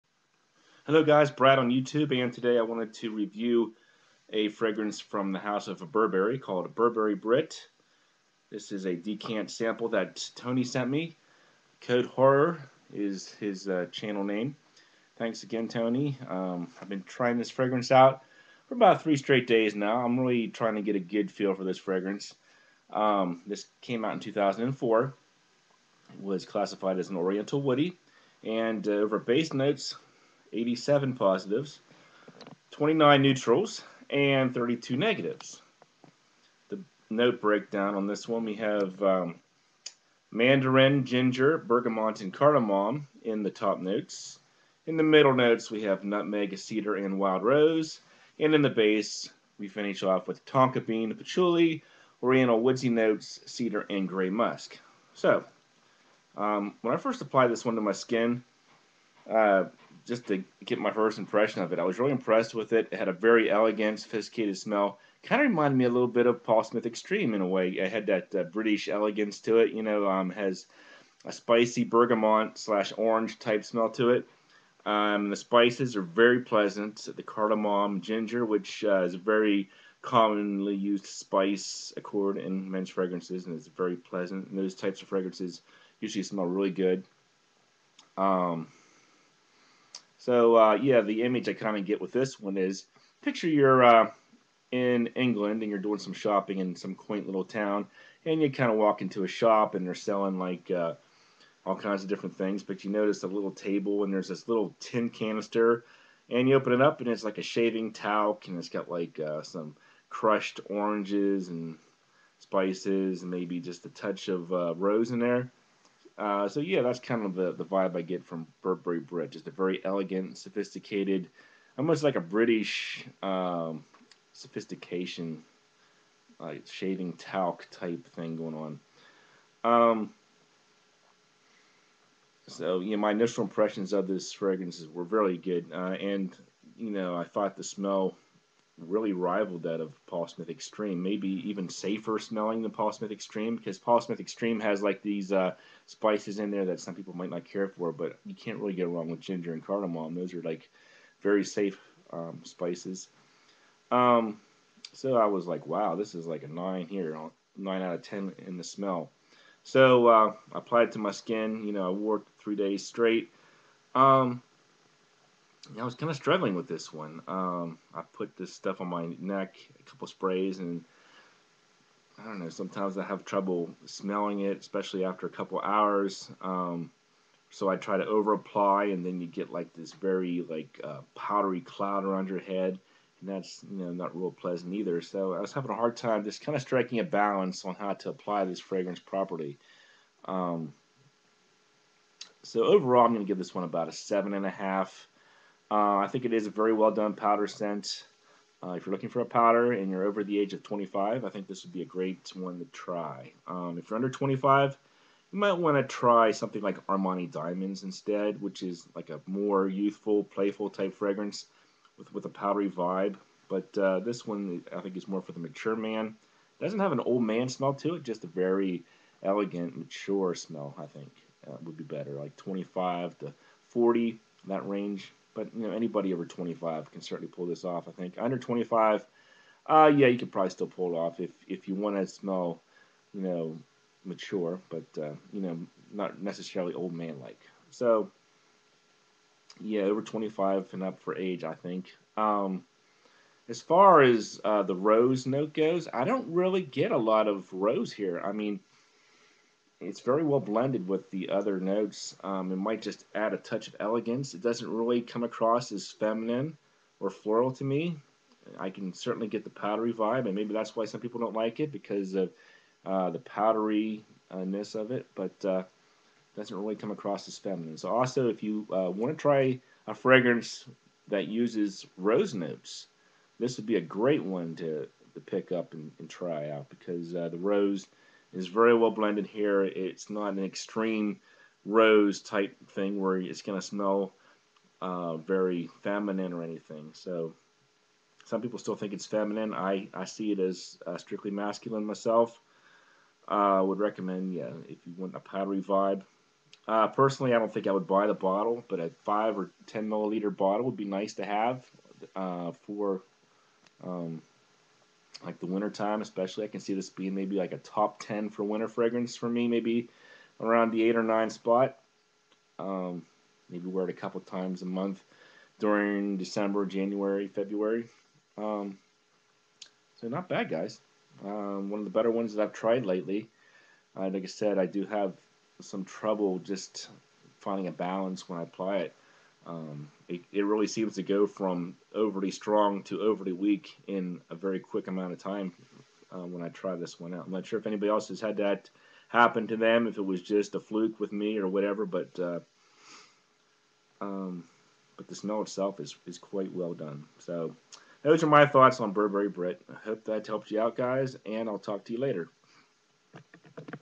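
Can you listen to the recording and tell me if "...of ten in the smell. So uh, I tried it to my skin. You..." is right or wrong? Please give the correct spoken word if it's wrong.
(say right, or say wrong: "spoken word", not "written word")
wrong: "applied", not "tried".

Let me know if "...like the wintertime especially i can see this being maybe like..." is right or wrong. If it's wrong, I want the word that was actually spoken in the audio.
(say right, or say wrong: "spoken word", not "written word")
right.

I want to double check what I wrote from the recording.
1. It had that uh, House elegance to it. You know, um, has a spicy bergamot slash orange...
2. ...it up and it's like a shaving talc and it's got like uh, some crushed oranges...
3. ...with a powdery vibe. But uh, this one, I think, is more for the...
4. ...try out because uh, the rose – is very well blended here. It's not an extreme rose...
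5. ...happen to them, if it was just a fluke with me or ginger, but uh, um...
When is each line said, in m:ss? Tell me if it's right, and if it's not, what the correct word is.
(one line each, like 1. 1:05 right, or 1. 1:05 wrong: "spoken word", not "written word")
1. 1:07 wrong: "British", not "House"
2. 1:46 right
3. 3:32 right
4. 4:36 right
5. 5:39 wrong: "whatever", not "ginger".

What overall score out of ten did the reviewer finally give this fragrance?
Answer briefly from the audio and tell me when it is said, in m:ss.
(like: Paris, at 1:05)
7.5, at 3:13.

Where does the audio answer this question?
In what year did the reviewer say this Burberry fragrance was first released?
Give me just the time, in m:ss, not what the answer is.
0:24.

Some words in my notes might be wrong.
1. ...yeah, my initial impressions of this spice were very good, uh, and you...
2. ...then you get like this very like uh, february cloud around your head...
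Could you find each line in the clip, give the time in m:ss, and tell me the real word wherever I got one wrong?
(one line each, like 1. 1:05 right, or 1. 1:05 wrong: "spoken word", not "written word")
1. 2:12 wrong: "fragrance", not "spice"
2. 2:59 wrong: "powdery", not "february".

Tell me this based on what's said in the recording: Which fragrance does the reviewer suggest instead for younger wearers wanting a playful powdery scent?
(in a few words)
Armani Diamonds.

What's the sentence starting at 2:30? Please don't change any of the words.
Those are like very safe um, spices.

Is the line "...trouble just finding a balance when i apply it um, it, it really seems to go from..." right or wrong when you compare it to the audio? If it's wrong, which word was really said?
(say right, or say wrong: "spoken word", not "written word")
right.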